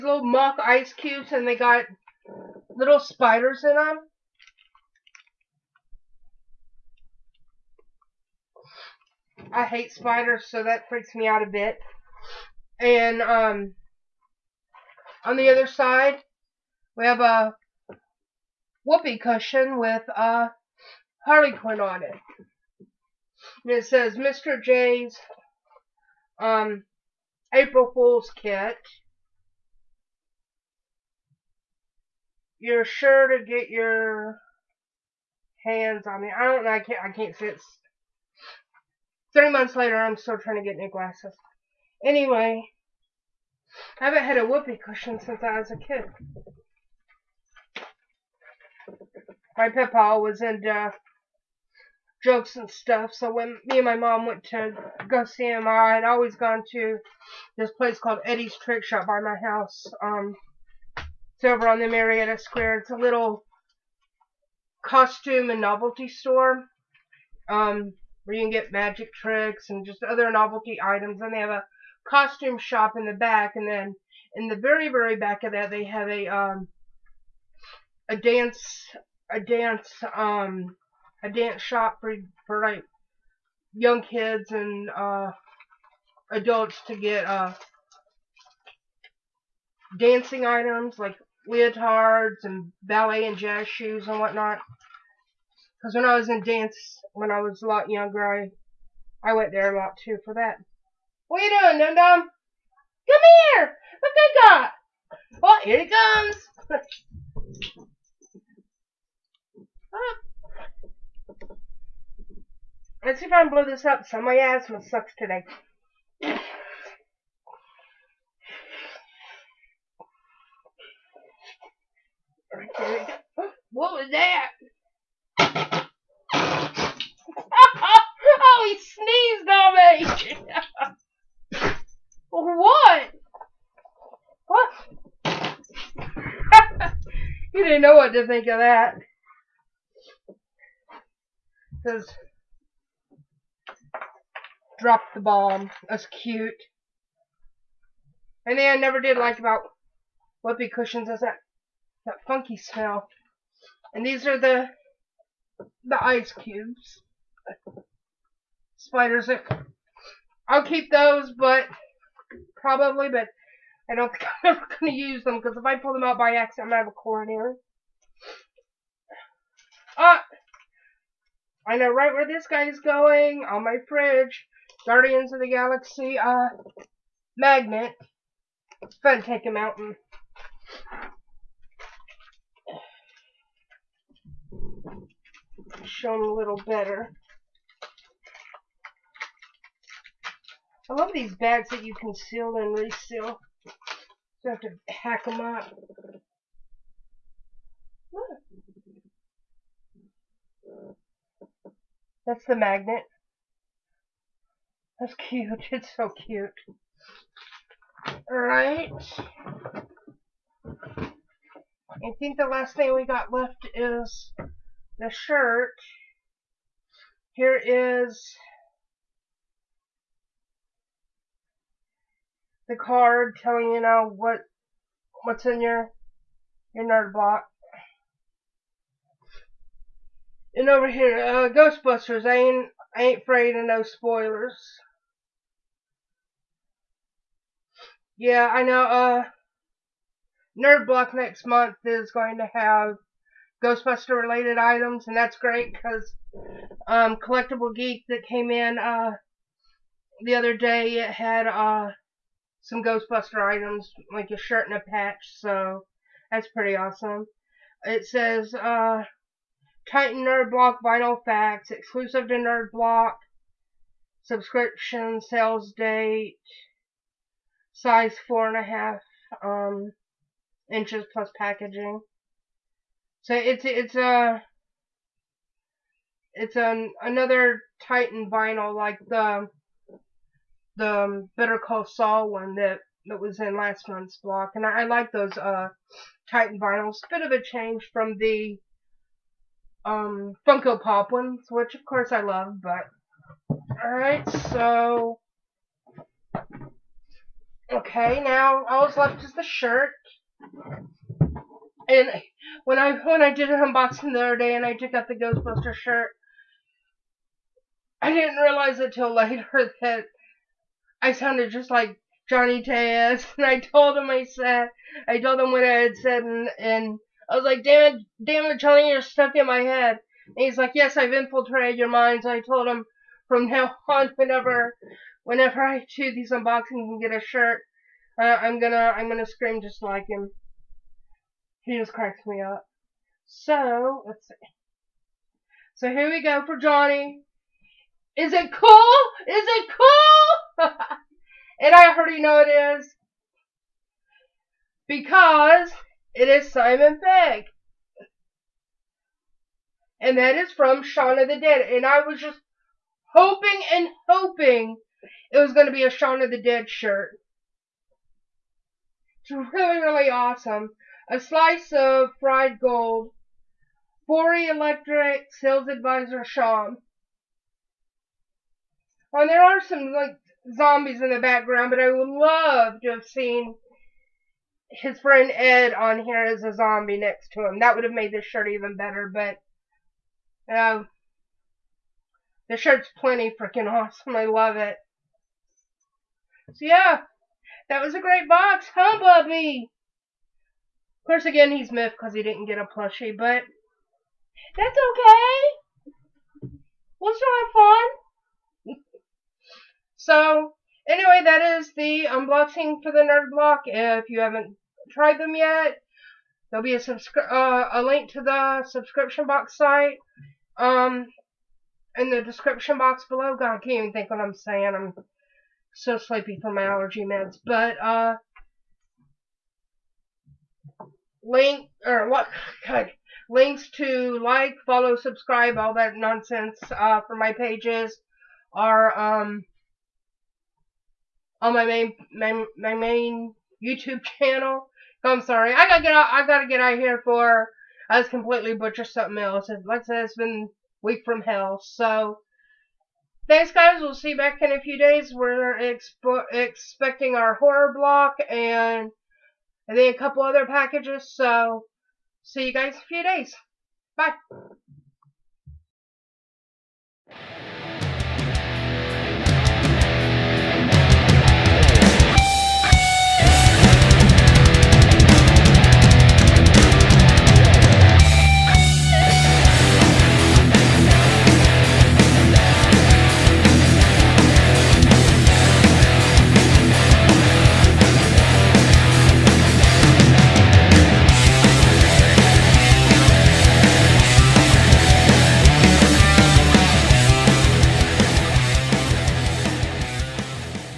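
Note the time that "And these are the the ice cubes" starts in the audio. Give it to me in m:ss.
2:33.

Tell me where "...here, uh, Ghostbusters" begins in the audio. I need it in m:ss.
3:50.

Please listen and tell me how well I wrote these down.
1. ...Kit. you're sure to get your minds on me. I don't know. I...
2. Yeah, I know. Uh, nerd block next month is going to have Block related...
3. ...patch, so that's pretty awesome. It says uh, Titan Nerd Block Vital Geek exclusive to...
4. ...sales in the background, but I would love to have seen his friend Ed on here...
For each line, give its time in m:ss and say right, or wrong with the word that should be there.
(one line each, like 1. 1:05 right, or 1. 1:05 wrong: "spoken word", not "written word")
1. 0:28 wrong: "hands", not "minds"
2. 3:58 wrong: "Ghostbuster", not "Block"
3. 4:14 wrong: "Facts", not "Geek"
4. 6:10 wrong: "zombies", not "sales".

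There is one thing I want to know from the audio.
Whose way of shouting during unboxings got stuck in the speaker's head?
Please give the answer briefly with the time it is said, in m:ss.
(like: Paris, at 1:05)
Johnny Taz, at 5:12.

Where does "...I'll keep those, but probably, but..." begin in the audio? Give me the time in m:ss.
2:40.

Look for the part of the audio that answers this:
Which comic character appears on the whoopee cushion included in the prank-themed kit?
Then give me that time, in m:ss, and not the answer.
0:21.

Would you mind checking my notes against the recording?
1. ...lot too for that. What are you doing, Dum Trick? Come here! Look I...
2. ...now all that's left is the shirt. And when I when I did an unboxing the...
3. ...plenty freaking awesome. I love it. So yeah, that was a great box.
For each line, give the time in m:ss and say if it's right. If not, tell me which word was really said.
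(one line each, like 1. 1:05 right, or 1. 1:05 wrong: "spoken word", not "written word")
1. 1:39 wrong: "Dum", not "Trick"
2. 4:58 right
3. 6:22 right.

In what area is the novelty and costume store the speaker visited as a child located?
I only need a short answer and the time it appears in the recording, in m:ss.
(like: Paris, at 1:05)
Marietta Square, at 1:01.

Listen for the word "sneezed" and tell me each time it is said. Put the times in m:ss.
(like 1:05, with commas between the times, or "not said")
2:10.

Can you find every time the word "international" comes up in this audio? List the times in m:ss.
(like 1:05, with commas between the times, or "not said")
not said.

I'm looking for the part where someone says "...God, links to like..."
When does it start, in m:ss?
7:02.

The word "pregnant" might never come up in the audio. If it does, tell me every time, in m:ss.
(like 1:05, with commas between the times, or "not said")
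not said.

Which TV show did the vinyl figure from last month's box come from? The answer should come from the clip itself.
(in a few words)
Better Call Saul.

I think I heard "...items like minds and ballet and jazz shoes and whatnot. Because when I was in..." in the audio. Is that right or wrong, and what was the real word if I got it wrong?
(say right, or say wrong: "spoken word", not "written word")
wrong: "leotards", not "minds".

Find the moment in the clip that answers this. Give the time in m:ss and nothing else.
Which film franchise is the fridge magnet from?
2:54.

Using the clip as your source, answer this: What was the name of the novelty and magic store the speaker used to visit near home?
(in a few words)
Eddie's Trick Shop.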